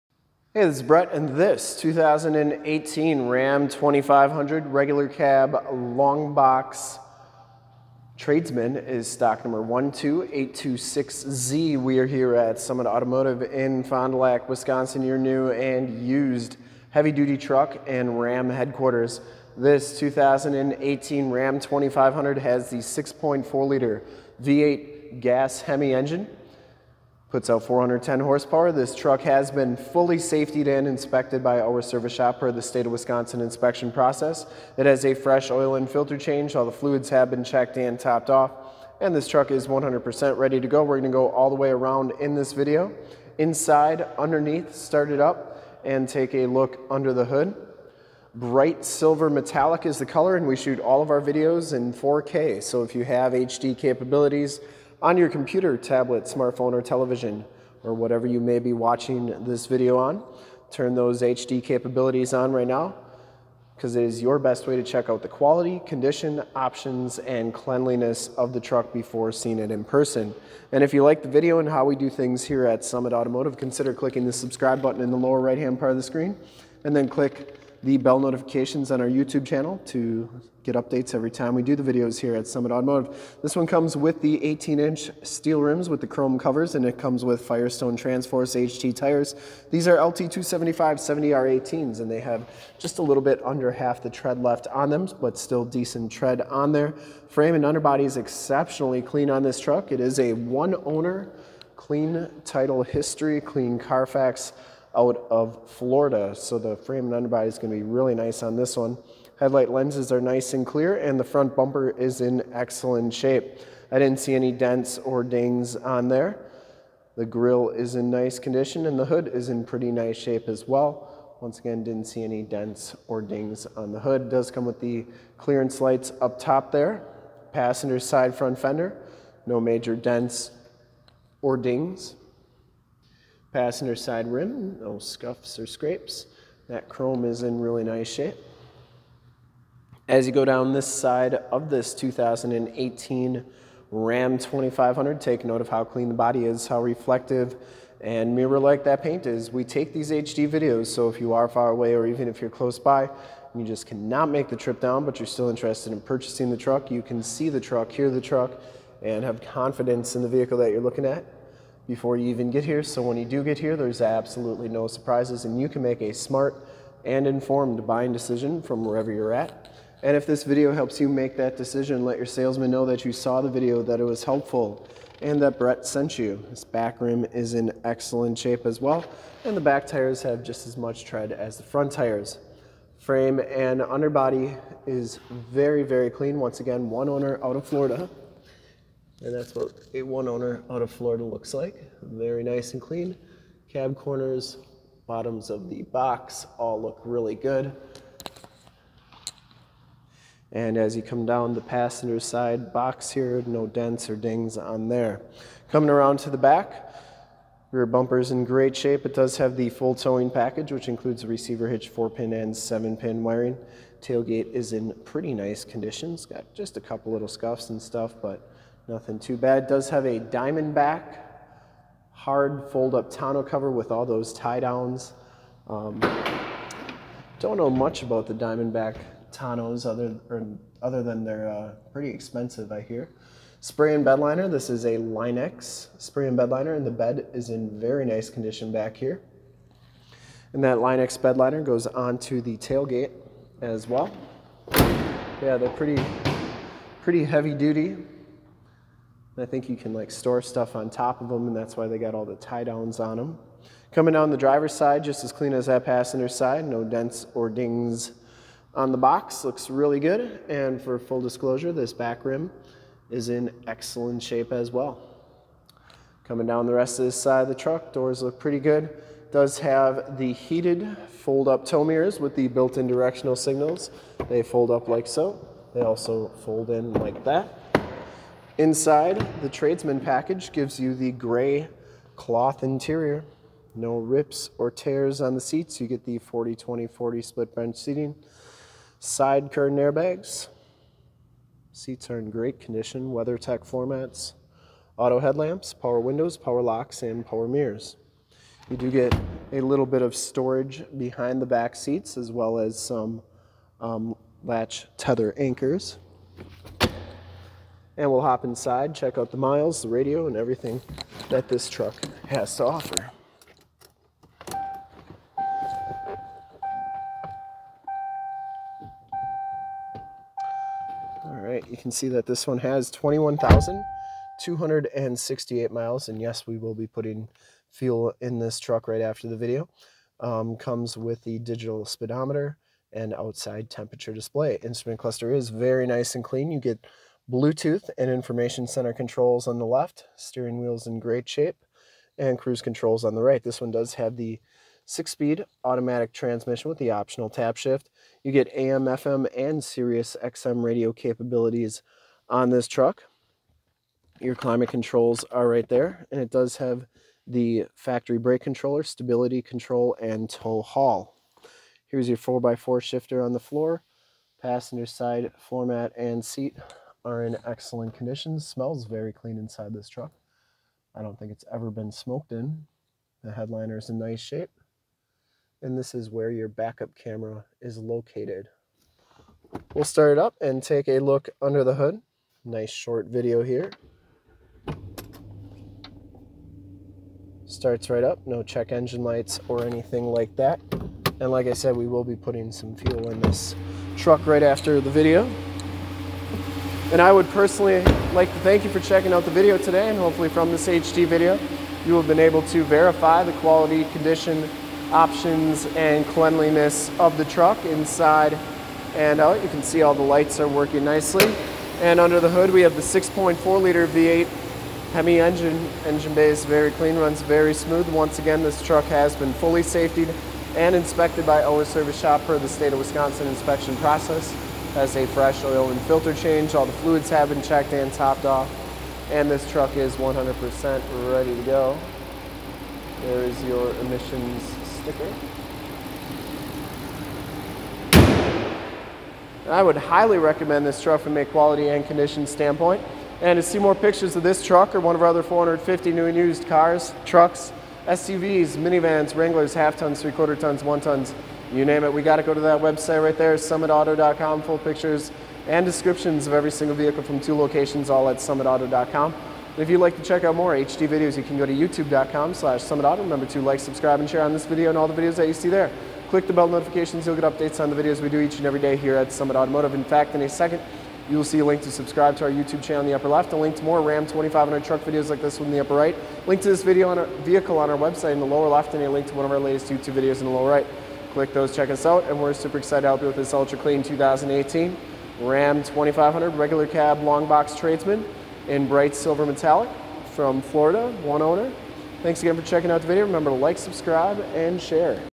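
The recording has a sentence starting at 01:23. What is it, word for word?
This one comes with the 18-inch steel rims with the chrome covers, and it comes with Firestone Transforce HT tires.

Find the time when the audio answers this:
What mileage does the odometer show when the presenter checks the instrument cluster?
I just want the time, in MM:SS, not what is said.
05:22.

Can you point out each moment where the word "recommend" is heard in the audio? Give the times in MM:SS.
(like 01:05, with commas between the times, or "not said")
07:20.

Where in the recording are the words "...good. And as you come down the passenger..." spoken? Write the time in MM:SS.
03:17.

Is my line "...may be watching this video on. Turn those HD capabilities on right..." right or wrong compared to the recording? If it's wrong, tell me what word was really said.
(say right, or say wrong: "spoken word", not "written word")
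right.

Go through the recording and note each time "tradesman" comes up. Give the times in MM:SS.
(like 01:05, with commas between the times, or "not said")
00:08, 04:39, 08:07.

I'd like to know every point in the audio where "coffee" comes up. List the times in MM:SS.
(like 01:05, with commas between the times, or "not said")
not said.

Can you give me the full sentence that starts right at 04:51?
Seats are in great condition, WeatherTech formats, auto headlamps, power windows, power locks, and power mirrors.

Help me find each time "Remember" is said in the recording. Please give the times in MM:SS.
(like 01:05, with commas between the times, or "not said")
07:42, 08:13.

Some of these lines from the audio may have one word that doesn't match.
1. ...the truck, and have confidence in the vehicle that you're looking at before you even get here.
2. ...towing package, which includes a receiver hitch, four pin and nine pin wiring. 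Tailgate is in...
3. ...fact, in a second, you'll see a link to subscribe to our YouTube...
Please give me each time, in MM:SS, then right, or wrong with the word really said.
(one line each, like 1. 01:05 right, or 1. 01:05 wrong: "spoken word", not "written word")
1. 02:38 right
2. 03:29 wrong: "seven", not "nine"
3. 07:49 right.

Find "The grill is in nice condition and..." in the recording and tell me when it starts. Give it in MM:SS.
01:57.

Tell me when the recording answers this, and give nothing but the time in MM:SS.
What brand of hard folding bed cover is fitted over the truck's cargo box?
03:40.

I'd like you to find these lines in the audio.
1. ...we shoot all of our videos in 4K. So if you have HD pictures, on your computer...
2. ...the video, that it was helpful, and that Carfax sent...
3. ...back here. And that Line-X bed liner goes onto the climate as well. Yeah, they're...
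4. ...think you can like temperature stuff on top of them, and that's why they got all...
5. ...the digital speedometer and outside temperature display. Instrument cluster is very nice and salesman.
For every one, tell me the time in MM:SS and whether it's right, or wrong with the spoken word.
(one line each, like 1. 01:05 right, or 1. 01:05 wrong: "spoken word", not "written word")
1. 00:50 wrong: "capabilities", not "pictures"
2. 02:53 wrong: "Brett", not "Carfax"
3. 03:58 wrong: "tailgate", not "climate"
4. 04:09 wrong: "store", not "temperature"
5. 05:31 wrong: "clean", not "salesman".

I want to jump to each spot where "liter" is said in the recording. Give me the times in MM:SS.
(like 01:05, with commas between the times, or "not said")
00:23, 06:53.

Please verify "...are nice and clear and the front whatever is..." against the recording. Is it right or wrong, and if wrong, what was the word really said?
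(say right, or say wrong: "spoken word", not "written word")
wrong: "bumper", not "whatever".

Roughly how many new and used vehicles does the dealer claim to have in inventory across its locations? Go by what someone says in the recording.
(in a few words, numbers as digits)
450.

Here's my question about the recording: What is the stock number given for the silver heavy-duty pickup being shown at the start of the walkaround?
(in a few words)
12826Z.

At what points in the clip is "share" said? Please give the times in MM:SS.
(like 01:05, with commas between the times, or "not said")
07:44, 08:14.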